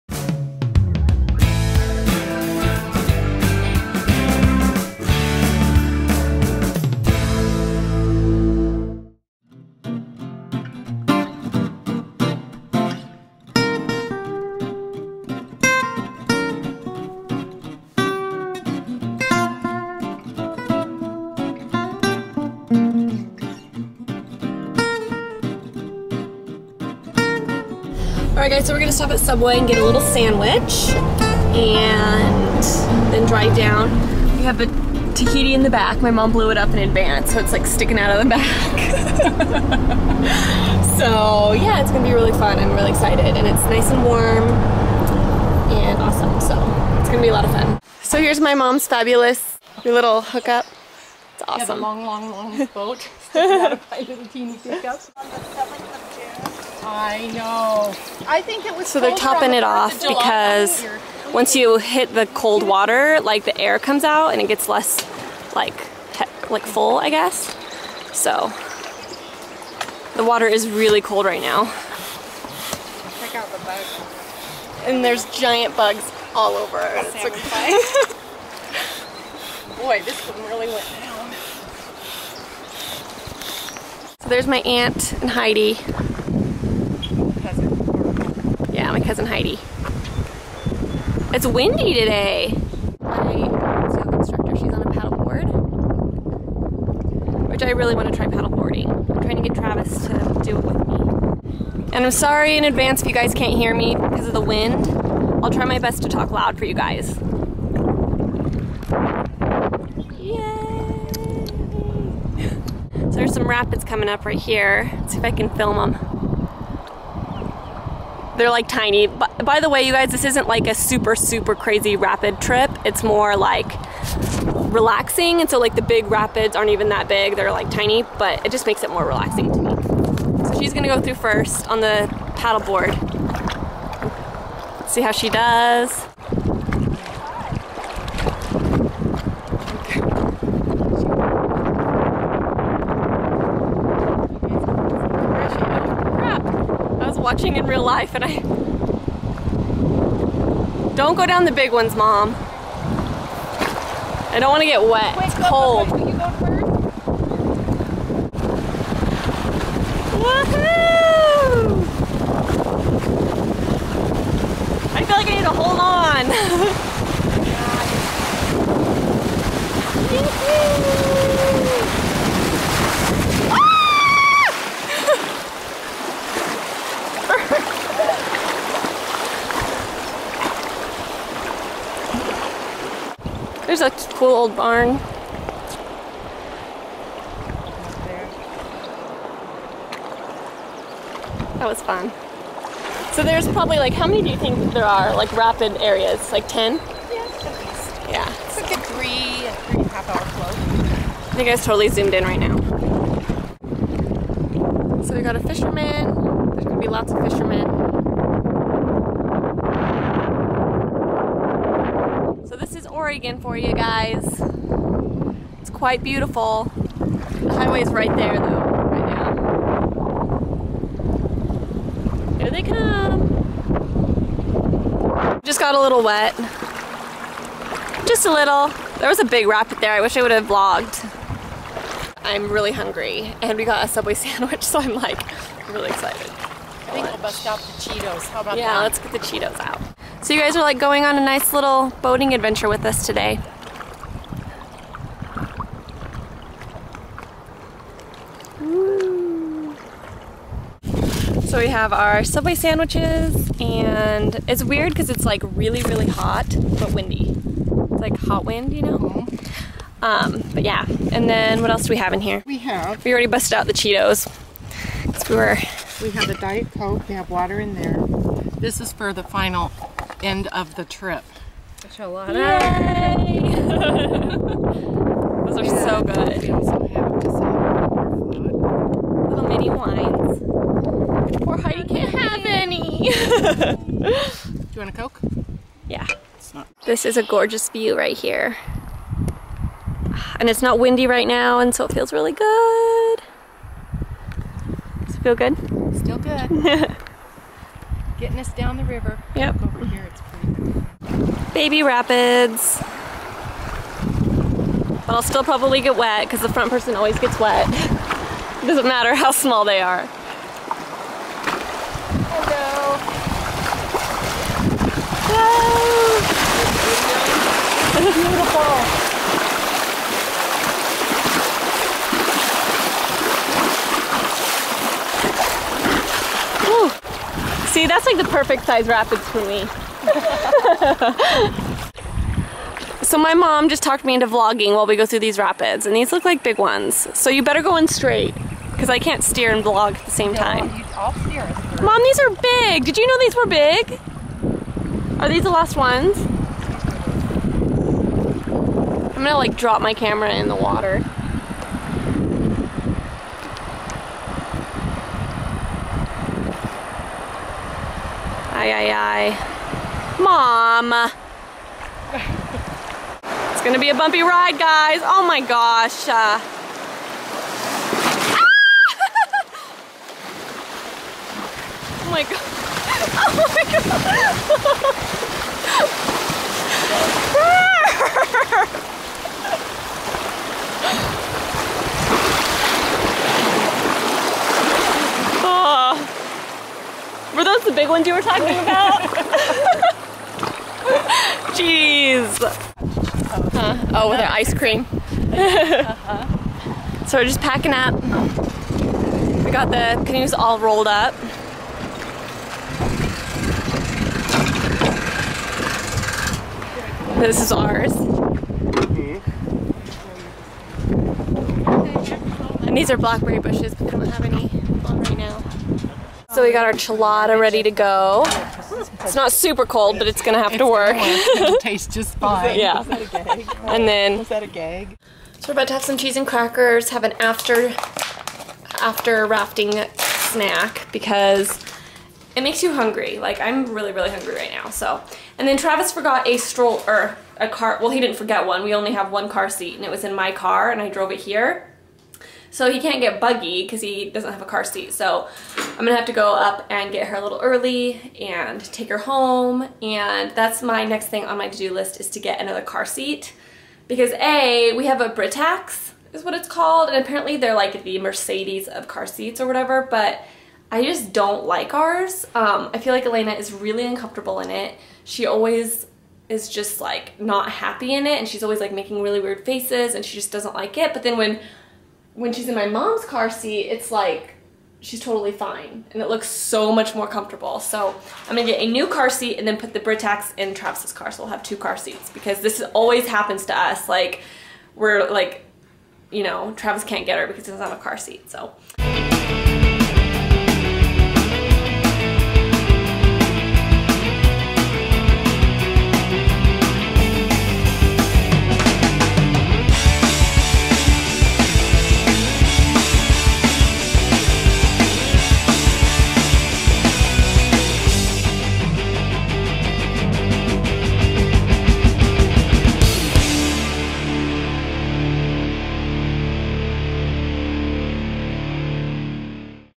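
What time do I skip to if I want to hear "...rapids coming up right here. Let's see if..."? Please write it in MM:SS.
01:53.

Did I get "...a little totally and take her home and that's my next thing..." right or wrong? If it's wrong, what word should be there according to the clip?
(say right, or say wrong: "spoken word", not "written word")
wrong: "early", not "totally".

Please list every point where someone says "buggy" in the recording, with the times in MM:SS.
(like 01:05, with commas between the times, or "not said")
07:23.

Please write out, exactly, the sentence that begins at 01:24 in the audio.
So there's my aunt and Heidi.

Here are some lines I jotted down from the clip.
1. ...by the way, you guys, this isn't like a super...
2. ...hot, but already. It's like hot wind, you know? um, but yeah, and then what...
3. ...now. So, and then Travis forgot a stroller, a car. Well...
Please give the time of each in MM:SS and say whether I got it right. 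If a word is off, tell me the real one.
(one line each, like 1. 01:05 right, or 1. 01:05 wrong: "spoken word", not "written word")
1. 01:59 right
2. 04:16 wrong: "windy", not "already"
3. 07:14 right.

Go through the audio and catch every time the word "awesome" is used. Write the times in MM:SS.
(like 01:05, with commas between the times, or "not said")
00:46, 00:51.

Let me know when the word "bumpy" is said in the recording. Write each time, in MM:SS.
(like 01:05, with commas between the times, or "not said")
06:03.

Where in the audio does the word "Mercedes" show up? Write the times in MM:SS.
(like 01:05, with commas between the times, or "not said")
07:37.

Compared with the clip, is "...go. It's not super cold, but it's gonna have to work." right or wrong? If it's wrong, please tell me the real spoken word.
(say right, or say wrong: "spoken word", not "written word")
right.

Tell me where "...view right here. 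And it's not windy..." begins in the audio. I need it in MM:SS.
04:47.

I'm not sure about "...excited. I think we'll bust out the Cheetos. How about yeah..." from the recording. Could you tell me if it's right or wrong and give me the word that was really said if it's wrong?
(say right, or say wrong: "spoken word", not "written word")
right.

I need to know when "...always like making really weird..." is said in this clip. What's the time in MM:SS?
07:48.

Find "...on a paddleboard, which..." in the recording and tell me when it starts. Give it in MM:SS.
01:34.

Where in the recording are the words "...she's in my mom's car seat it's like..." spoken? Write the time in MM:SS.
07:52.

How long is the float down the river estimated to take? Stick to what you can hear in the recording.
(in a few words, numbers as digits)
3 and a half hours.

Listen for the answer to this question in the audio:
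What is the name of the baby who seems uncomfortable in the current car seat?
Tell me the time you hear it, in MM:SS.
07:43.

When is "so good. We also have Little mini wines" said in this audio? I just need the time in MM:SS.
04:35.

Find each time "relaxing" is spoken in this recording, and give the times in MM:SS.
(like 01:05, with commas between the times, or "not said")
02:04, 02:09.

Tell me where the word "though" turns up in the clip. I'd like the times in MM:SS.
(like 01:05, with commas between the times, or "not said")
03:38.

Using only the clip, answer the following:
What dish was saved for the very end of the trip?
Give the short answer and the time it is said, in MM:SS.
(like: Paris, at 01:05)
Enchilada, at 04:31.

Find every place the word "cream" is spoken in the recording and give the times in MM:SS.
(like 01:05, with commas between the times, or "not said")
06:34.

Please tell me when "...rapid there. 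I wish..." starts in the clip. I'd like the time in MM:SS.
03:49.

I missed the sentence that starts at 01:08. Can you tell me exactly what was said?
So the water is really cold right now.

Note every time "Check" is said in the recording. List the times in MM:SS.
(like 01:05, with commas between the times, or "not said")
01:13.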